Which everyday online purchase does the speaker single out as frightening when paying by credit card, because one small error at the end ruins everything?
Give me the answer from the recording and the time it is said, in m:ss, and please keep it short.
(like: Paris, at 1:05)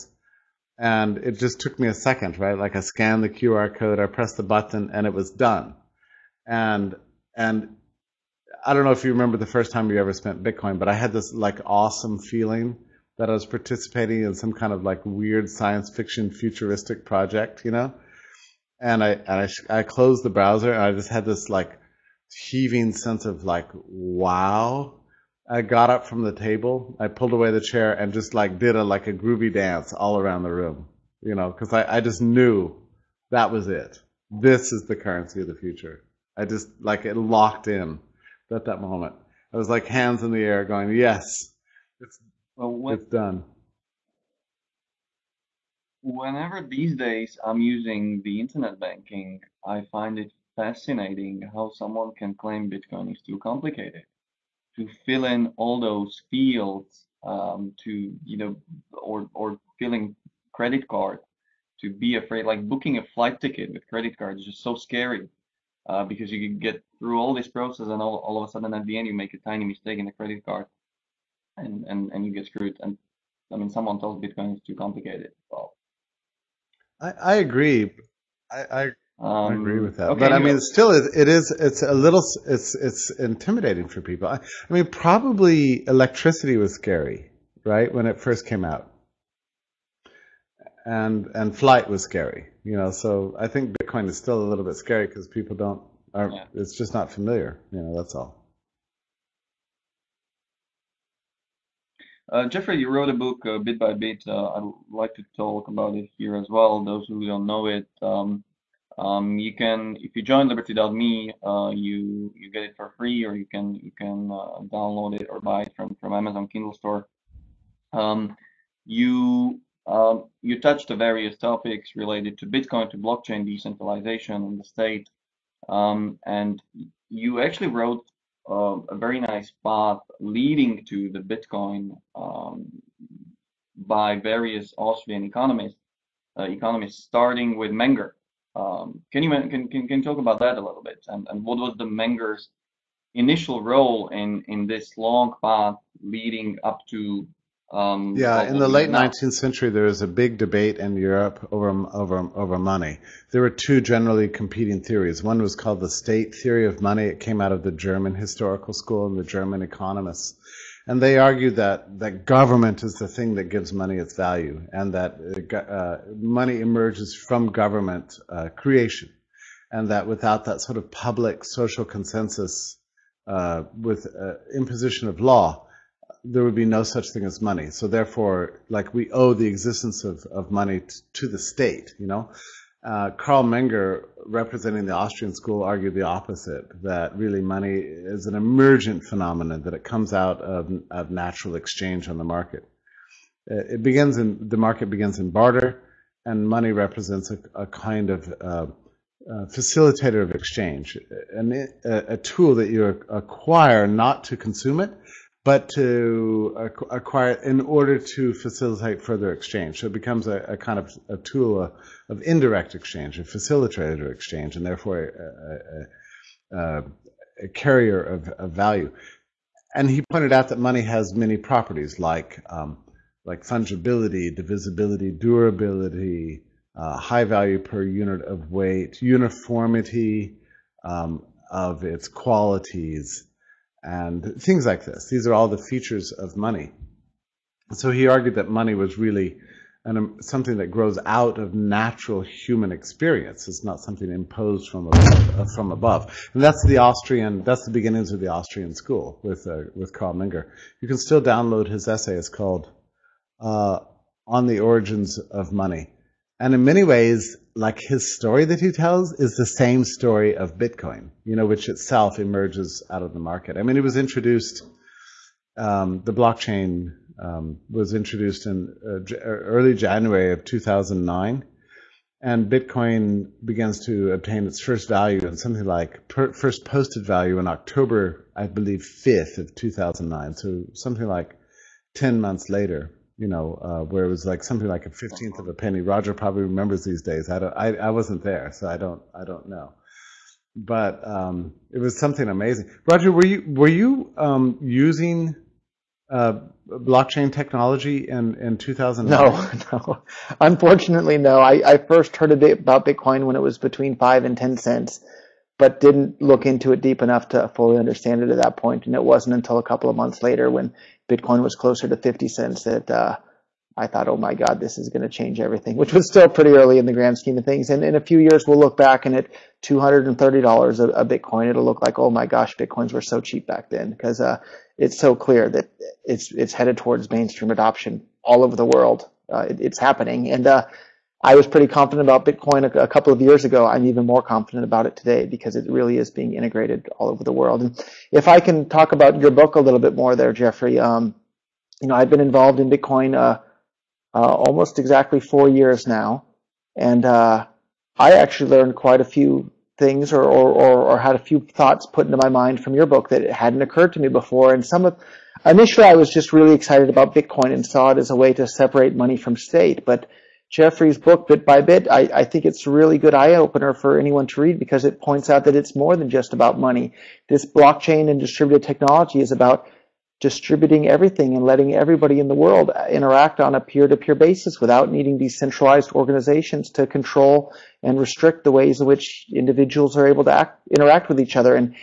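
booking a flight ticket, at 1:02.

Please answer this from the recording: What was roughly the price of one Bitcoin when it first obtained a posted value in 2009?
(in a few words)
a fifteenth of a penny.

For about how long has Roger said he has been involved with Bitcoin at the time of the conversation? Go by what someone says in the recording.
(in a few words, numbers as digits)
four years.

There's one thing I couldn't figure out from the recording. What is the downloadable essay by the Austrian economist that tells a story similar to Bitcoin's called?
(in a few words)
On the Origins of Money.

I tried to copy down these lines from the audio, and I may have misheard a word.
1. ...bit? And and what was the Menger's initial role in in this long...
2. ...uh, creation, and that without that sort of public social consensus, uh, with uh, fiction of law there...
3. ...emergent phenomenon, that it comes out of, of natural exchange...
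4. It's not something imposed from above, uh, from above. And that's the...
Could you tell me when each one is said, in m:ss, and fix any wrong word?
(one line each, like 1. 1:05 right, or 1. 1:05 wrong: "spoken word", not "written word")
1. 2:20 right
2. 2:48 wrong: "imposition", not "fiction"
3. 3:08 right
4. 4:03 right.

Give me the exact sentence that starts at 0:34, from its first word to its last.
This is the currency of the future.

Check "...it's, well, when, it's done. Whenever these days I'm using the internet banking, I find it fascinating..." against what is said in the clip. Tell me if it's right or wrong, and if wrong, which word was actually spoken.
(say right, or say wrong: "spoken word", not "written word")
right.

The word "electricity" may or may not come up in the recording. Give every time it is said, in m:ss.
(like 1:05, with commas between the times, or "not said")
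1:25.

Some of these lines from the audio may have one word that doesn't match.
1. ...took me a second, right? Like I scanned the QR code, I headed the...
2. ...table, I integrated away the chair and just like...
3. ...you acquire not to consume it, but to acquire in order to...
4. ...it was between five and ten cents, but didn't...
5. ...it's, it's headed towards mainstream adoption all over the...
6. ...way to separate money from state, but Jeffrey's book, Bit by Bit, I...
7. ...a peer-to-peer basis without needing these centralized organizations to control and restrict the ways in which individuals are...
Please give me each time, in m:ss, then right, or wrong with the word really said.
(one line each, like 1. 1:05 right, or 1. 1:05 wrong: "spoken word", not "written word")
1. 0:01 wrong: "pressed", not "headed"
2. 0:26 wrong: "pulled", not "integrated"
3. 3:22 right
4. 5:03 right
5. 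5:26 right
6. 5:58 right
7. 6:13 right.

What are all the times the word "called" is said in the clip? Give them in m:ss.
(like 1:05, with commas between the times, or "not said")
2:35, 4:12.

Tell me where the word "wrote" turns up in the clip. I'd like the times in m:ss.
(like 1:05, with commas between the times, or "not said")
1:42, 2:07.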